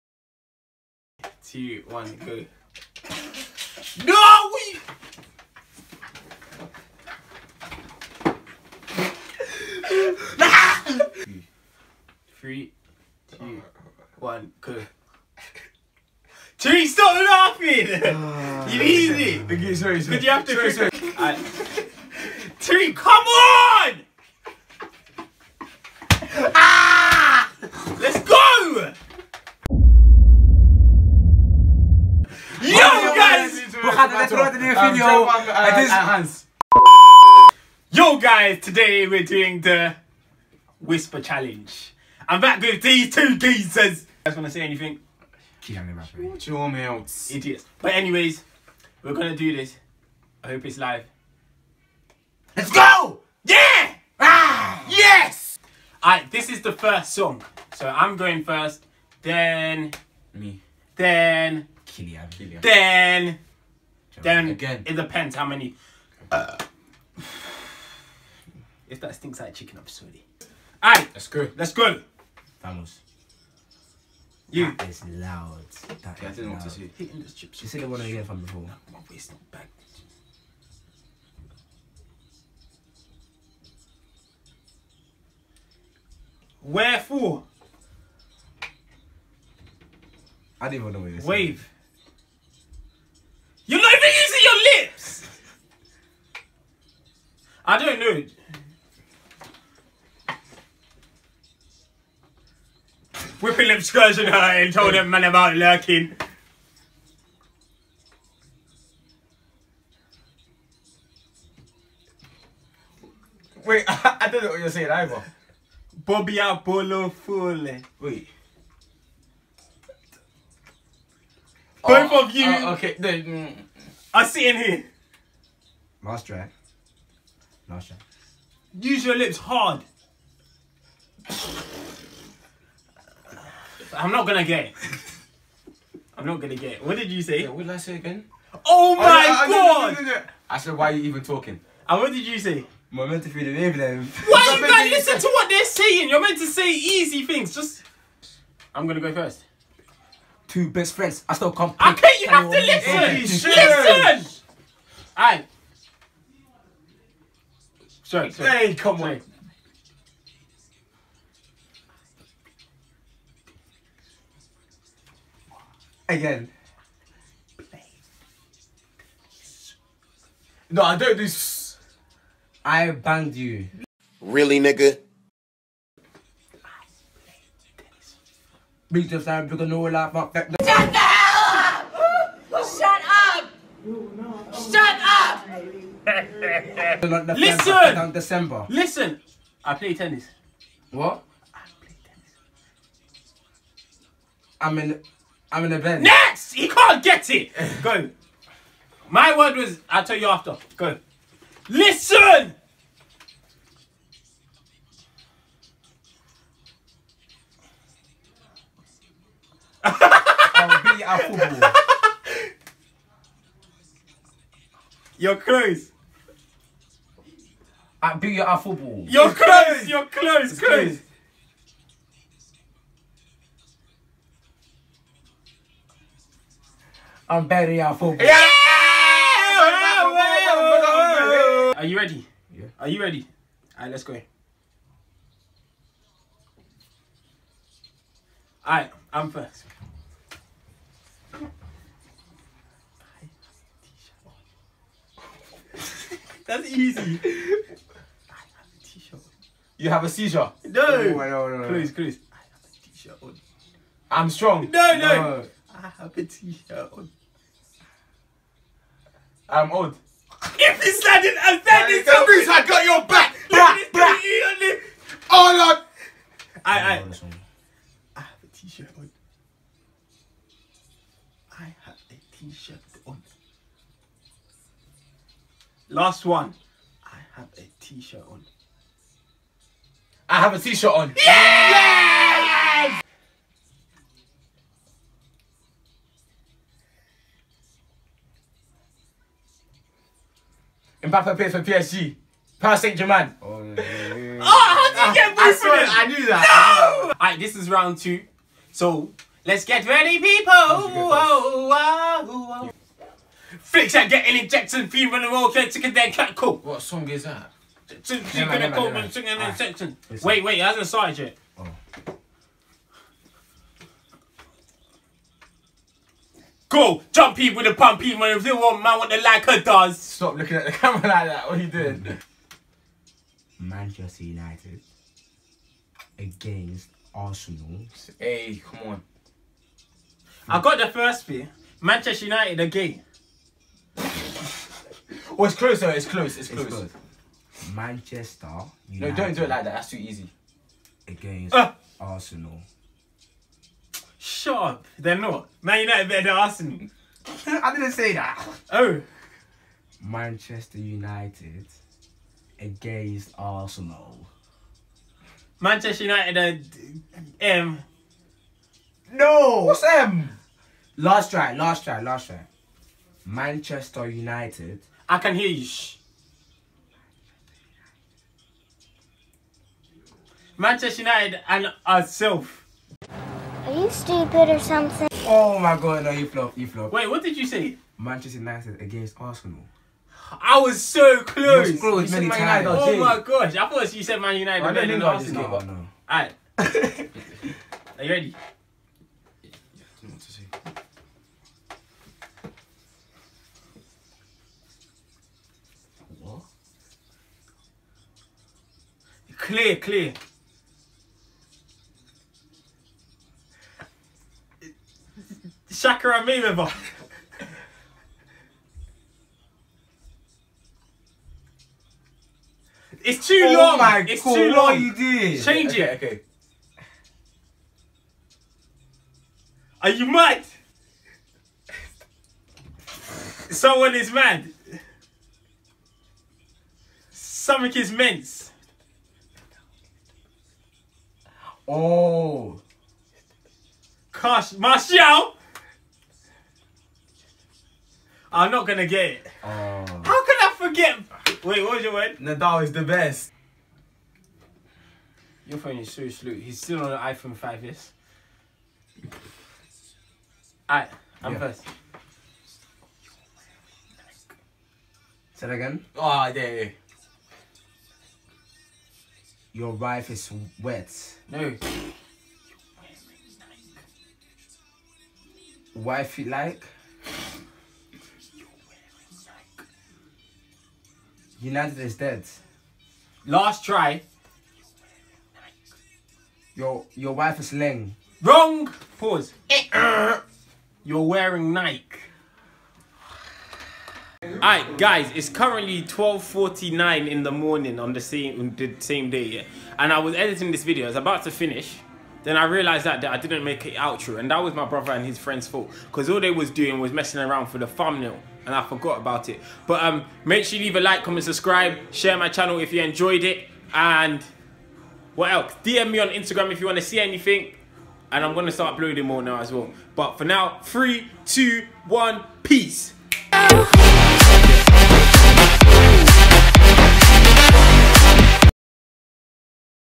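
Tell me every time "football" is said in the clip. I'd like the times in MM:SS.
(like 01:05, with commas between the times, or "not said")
03:31, 03:38, 03:47.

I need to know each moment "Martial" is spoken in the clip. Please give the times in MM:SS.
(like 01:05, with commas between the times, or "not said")
07:14.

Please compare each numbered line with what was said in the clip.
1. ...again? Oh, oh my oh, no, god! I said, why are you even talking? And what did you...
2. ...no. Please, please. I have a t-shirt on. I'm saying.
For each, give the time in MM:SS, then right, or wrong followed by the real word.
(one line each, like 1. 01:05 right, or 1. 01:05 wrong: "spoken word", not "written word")
1. 02:17 right
2. 04:11 wrong: "strong", not "saying".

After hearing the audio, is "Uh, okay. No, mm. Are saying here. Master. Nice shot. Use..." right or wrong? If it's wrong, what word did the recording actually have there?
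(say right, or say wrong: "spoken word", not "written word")
wrong: "sitting", not "saying".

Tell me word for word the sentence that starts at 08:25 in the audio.
DM me on Instagram if you want to see anything, and I'm gonna start uploading more now as well.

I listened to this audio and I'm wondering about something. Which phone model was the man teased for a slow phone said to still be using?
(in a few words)
iPhone 5S.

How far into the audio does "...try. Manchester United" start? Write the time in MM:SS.
06:02.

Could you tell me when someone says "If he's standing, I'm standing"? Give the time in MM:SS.
04:20.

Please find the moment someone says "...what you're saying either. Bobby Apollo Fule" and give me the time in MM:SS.
01:54.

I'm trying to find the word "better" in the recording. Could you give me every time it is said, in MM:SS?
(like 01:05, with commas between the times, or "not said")
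03:47, 05:46.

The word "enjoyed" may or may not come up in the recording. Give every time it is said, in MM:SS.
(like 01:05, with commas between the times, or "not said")
08:22.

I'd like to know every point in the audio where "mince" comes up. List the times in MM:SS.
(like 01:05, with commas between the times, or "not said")
07:07.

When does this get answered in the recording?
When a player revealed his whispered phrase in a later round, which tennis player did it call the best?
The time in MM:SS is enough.
07:22.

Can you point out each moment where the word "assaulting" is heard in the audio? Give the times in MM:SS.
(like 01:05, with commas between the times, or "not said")
not said.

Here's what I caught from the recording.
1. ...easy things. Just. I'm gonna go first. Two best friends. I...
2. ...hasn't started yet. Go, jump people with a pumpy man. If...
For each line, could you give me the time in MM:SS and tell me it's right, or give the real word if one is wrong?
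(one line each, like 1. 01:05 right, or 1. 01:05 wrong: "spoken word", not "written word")
1. 02:26 right
2. 05:10 right.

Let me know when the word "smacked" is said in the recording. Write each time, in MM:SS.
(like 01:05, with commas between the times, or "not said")
not said.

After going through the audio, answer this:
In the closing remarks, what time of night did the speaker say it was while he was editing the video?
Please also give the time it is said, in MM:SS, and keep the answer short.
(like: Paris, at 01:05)
12:49, at 08:05.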